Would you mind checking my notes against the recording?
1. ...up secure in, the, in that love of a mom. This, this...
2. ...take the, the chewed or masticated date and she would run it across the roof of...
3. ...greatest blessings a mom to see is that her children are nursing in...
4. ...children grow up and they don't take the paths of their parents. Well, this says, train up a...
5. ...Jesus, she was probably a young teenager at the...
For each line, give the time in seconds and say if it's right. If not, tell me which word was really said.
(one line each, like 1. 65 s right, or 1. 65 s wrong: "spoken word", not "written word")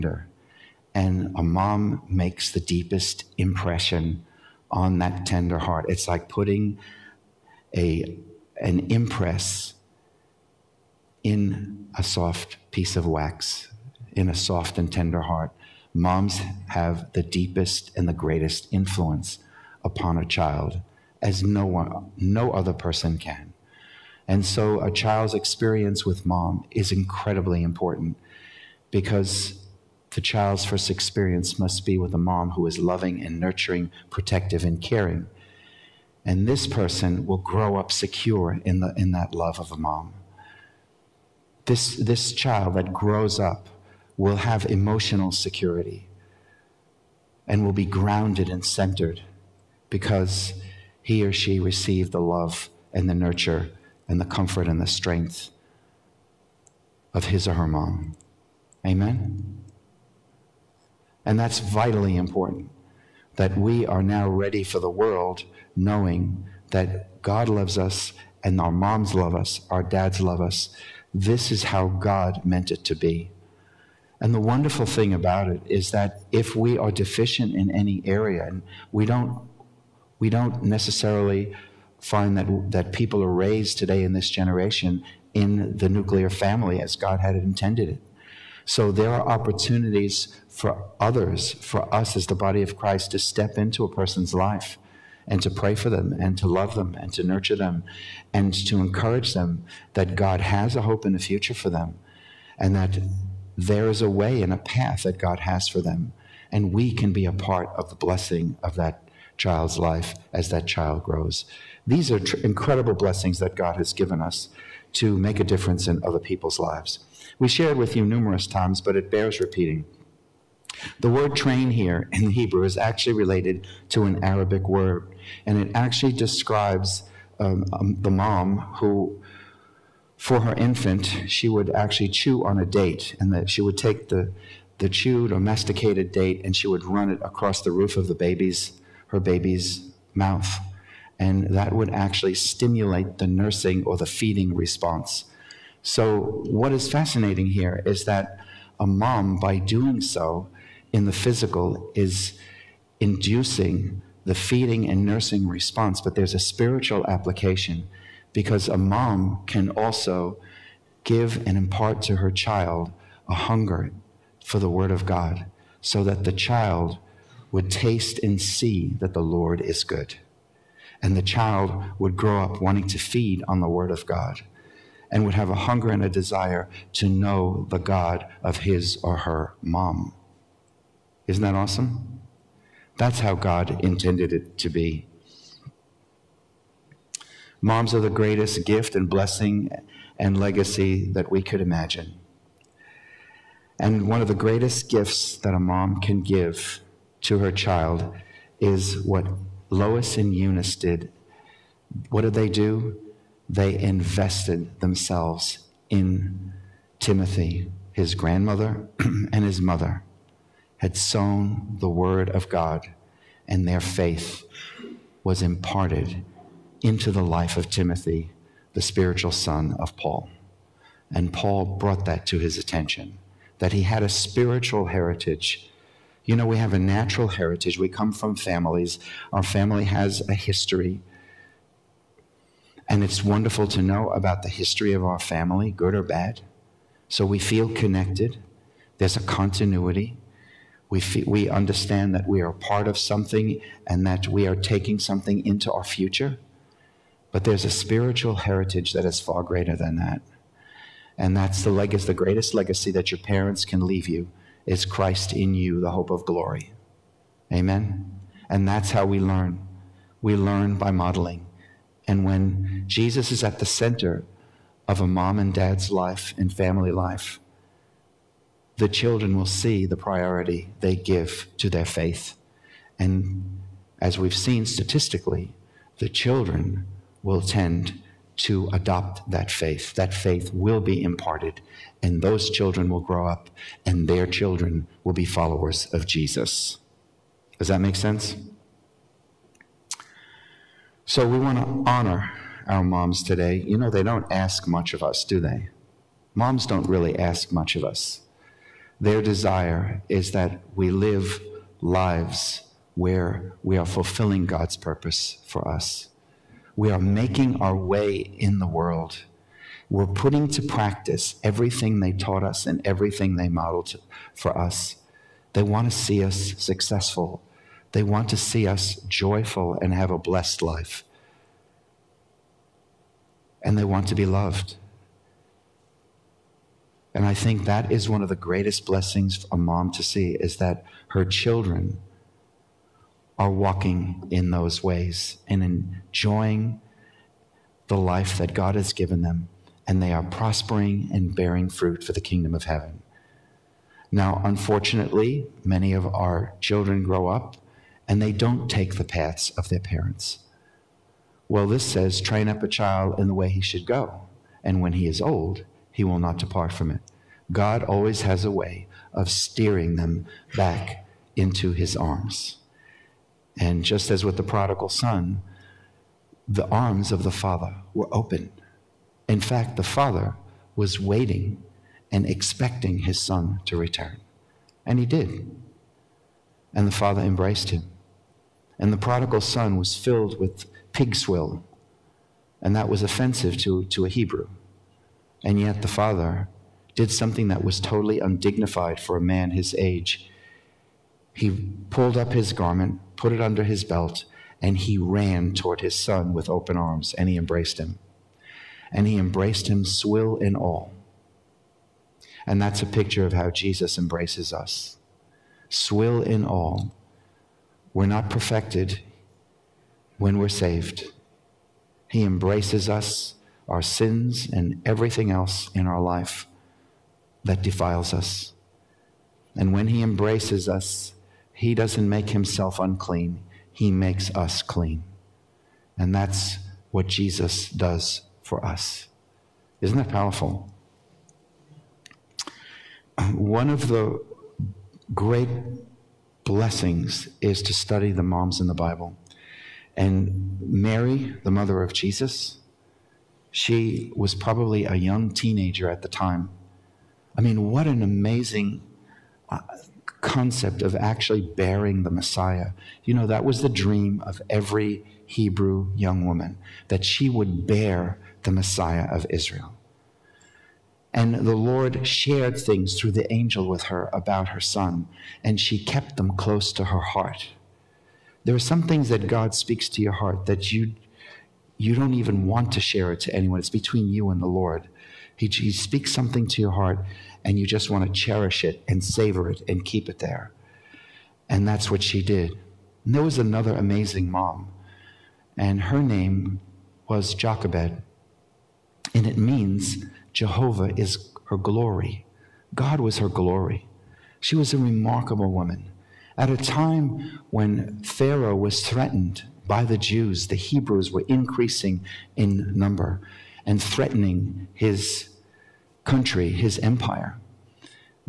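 1. 37 s right
2. 133 s right
3. 328 s wrong: "walking", not "nursing"
4. 346 s right
5. 441 s right.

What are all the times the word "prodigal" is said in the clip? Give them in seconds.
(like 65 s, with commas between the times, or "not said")
364 s, 378 s.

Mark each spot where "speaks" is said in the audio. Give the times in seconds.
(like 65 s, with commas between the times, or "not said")
469 s, 475 s.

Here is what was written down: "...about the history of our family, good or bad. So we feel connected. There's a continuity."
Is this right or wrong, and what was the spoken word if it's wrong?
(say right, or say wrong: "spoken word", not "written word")
right.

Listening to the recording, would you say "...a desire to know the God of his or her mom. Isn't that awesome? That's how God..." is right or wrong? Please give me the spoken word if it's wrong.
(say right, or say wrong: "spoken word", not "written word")
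right.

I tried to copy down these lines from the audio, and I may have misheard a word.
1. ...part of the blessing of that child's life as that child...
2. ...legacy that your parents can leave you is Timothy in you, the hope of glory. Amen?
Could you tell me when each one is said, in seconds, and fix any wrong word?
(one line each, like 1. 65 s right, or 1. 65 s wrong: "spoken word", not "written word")
1. 107 s right
2. 252 s wrong: "Christ", not "Timothy".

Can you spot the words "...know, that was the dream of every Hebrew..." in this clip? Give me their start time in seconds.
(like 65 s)
453 s.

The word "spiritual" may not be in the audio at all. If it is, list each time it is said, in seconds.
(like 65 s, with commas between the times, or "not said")
156 s, 218 s, 224 s, 247 s.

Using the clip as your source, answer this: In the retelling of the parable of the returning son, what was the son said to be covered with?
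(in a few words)
Pig swill.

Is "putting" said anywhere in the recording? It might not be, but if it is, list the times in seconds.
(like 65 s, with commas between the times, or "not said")
6 s, 310 s.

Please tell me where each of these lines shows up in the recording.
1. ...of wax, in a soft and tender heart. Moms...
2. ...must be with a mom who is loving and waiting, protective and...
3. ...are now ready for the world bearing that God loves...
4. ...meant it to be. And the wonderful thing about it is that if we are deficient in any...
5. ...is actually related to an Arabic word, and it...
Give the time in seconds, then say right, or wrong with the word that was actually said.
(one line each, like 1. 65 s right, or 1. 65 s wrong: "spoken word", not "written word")
1. 12 s right
2. 31 s wrong: "nurturing", not "waiting"
3. 63 s wrong: "knowing", not "bearing"
4. 72 s right
5. 122 s right.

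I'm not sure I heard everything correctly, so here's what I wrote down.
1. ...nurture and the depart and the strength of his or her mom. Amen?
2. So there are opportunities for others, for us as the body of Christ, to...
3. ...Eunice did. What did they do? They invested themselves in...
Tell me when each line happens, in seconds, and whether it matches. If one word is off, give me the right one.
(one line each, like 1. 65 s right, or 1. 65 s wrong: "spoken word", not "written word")
1. 53 s wrong: "comfort", not "depart"
2. 88 s right
3. 200 s right.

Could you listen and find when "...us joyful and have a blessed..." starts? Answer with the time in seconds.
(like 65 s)
318 s.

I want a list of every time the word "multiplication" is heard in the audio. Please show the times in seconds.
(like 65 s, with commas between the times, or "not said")
not said.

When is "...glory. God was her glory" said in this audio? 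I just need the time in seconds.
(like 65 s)
491 s.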